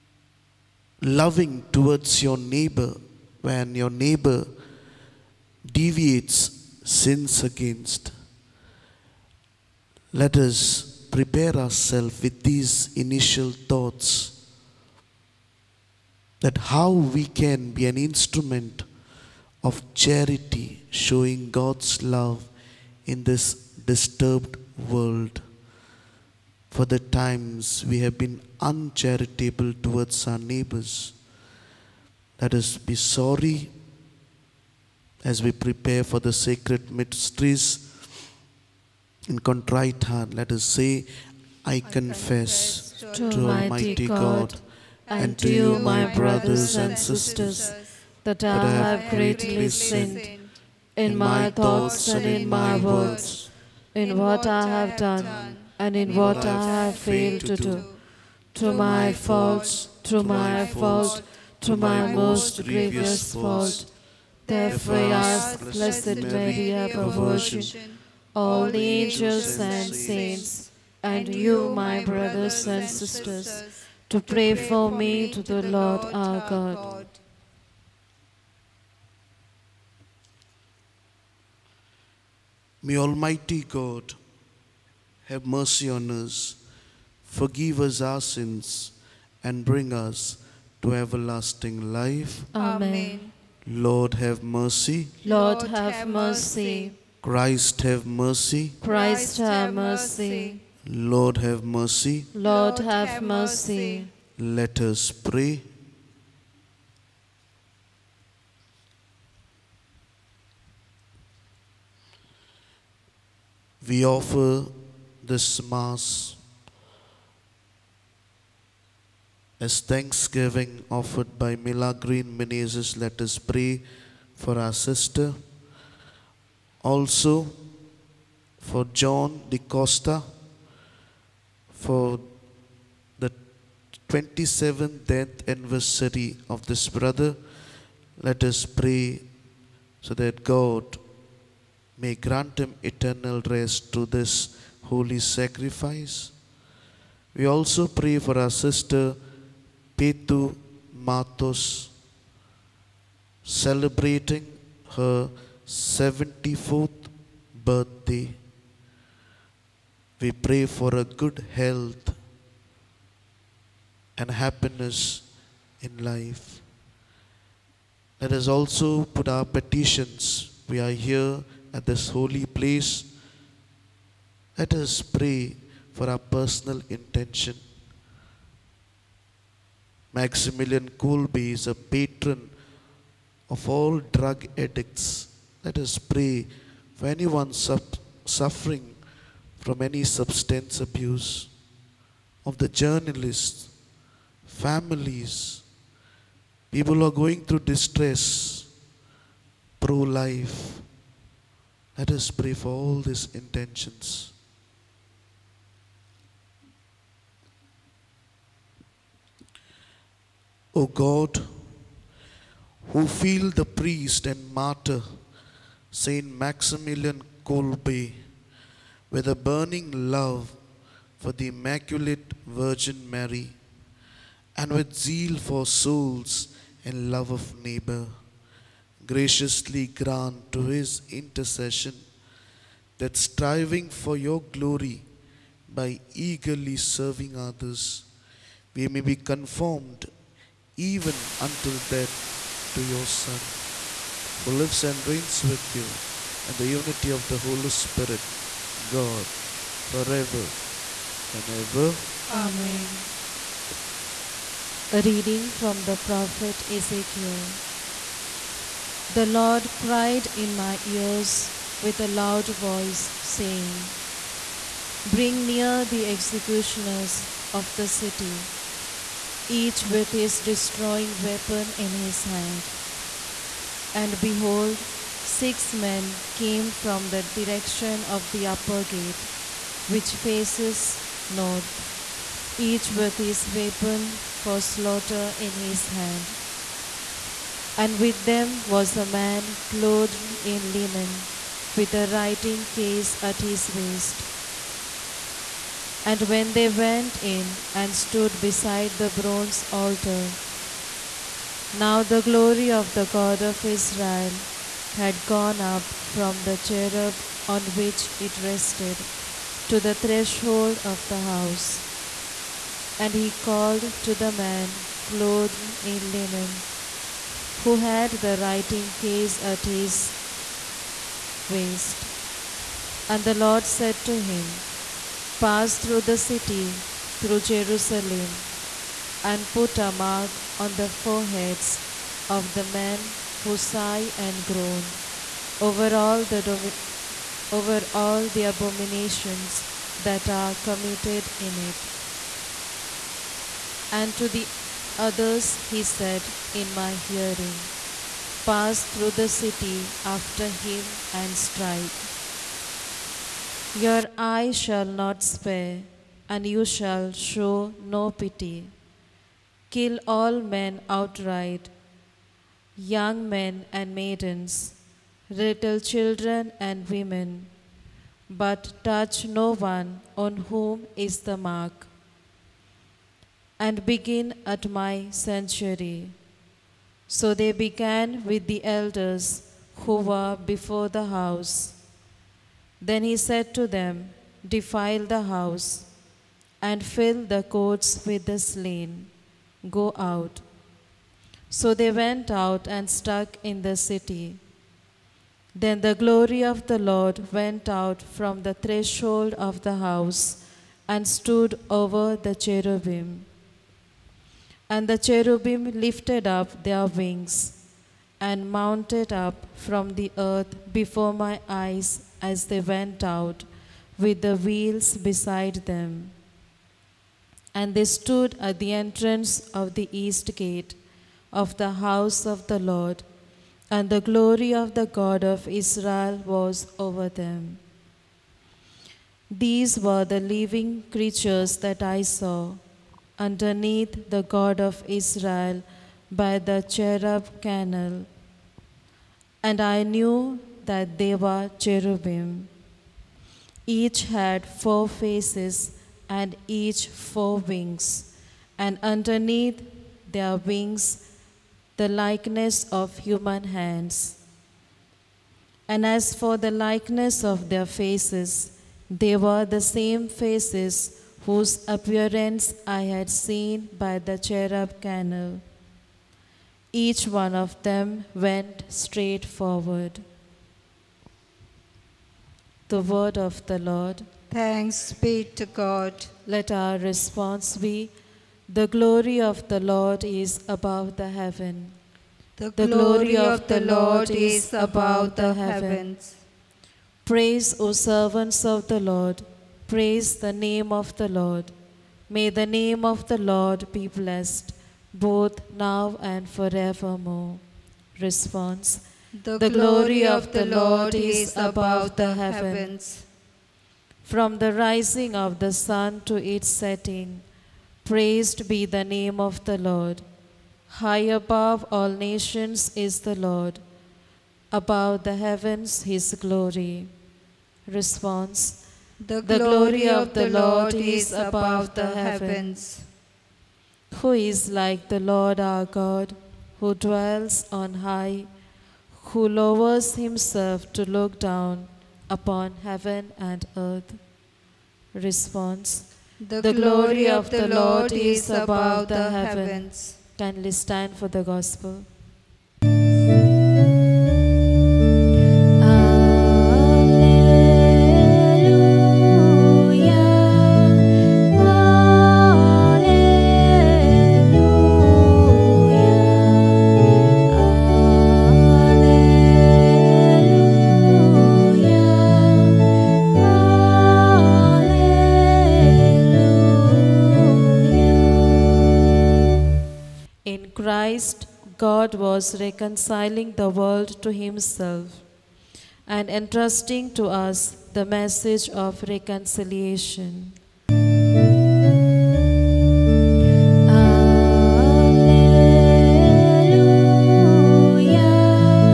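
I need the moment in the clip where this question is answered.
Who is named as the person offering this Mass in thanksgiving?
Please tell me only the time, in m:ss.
2:01.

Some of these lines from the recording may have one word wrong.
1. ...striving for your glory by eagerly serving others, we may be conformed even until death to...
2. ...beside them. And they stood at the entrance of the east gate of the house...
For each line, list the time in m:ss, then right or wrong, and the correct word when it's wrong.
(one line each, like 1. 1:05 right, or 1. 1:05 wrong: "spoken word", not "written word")
1. 3:53 right
2. 6:54 right.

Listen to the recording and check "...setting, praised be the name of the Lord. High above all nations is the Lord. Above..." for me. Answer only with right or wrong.
right.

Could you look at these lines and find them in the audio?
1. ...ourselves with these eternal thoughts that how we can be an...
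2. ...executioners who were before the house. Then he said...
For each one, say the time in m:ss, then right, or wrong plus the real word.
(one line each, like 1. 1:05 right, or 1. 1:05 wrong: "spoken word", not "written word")
1. 0:11 wrong: "initial", not "eternal"
2. 6:18 wrong: "elders", not "executioners".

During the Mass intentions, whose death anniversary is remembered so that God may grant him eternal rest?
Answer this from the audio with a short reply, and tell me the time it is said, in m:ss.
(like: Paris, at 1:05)
John de Costa, at 2:09.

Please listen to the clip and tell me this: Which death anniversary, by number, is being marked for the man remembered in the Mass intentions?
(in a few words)
27th.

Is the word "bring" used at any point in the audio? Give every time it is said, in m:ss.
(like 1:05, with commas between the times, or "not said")
1:29, 4:25.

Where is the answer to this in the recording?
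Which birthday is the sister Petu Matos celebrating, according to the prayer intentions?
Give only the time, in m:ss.
2:35.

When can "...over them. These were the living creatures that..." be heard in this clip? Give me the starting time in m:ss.
7:06.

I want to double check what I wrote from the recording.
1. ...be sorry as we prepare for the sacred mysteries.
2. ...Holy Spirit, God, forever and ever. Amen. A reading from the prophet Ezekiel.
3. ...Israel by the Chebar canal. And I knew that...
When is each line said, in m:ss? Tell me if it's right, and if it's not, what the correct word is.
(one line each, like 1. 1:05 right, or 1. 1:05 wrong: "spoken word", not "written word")
1. 0:32 right
2. 4:07 right
3. 7:14 right.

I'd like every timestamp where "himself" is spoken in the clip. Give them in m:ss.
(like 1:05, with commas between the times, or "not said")
8:49, 9:34.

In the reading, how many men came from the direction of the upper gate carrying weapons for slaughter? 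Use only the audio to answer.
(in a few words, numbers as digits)
6.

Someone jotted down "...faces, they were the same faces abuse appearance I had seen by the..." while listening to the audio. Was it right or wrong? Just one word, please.
wrong.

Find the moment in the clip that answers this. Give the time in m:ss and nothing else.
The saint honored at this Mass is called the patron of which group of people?
3:04.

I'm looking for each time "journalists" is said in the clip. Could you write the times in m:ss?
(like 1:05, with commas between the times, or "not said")
3:12.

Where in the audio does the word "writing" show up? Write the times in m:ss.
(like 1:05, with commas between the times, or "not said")
4:52, 5:18.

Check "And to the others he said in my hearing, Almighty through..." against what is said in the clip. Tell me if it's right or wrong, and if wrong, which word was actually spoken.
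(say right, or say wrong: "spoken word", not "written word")
wrong: "Pass", not "Almighty".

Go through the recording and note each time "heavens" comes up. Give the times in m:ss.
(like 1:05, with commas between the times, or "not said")
8:01, 8:05, 8:22, 8:35, 8:41, 8:52, 8:59.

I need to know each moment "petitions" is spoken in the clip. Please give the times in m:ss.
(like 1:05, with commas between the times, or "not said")
2:49.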